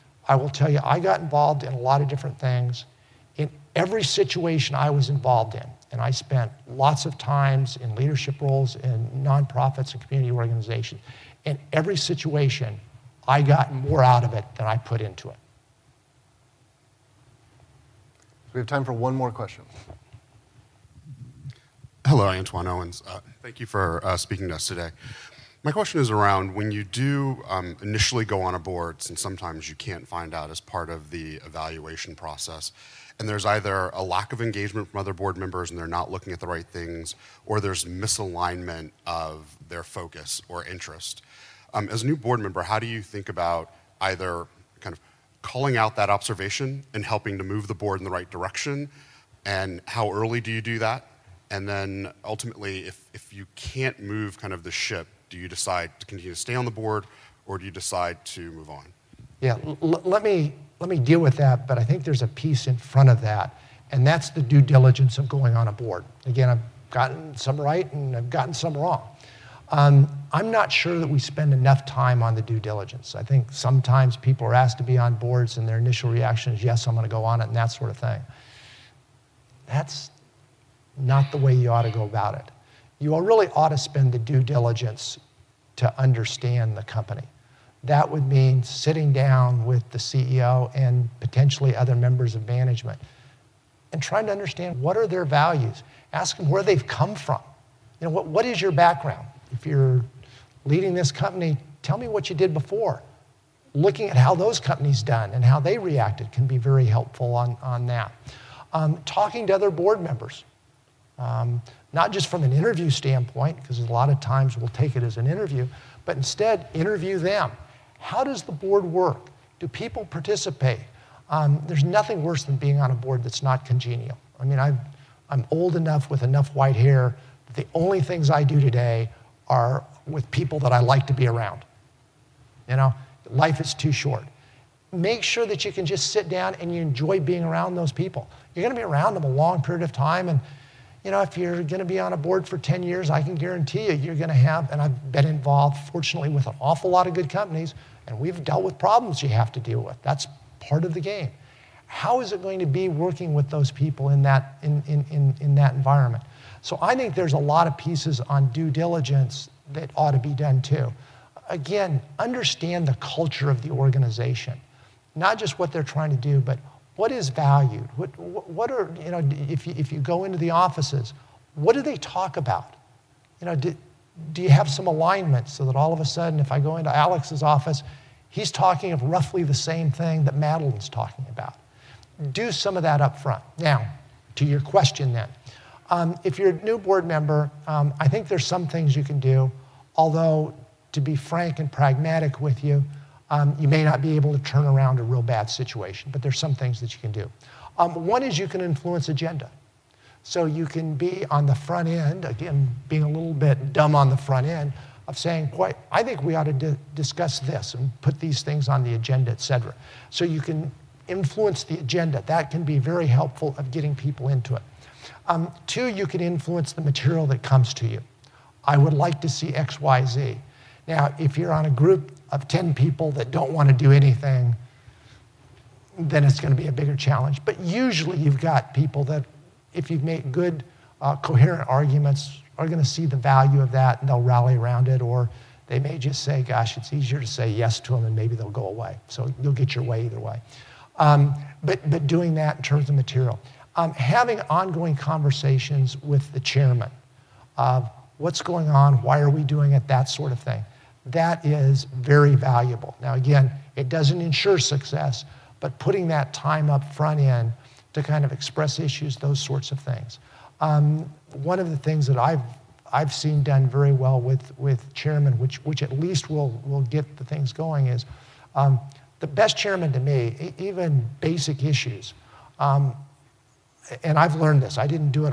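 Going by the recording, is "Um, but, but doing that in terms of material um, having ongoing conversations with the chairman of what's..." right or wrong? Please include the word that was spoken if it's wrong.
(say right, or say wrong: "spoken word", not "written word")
right.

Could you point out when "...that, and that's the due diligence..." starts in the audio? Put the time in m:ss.
1:03.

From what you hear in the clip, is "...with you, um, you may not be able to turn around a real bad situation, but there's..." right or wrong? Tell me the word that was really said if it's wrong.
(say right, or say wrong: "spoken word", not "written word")
right.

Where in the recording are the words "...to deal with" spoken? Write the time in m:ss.
2:29.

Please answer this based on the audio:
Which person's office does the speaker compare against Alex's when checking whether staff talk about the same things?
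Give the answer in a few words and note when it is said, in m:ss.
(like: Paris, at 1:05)
Madeline, at 3:00.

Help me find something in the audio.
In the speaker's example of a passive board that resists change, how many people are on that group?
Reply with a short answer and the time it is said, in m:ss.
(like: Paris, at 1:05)
10, at 3:42.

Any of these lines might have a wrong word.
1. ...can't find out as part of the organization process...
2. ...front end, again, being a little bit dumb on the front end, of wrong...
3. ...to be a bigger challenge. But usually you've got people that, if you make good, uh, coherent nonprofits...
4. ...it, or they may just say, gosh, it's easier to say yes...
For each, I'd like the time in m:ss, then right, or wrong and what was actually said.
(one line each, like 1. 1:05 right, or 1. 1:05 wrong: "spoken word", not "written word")
1. 0:29 wrong: "evaluation", not "organization"
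2. 3:21 wrong: "saying", not "wrong"
3. 3:46 wrong: "arguments", not "nonprofits"
4. 3:54 right.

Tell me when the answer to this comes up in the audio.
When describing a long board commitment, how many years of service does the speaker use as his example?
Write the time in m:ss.
2:22.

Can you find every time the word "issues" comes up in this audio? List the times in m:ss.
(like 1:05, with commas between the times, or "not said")
4:18, 4:31.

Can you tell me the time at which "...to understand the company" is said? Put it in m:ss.
1:25.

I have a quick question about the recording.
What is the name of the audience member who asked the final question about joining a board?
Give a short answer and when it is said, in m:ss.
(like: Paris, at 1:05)
Antoine Owens, at 0:22.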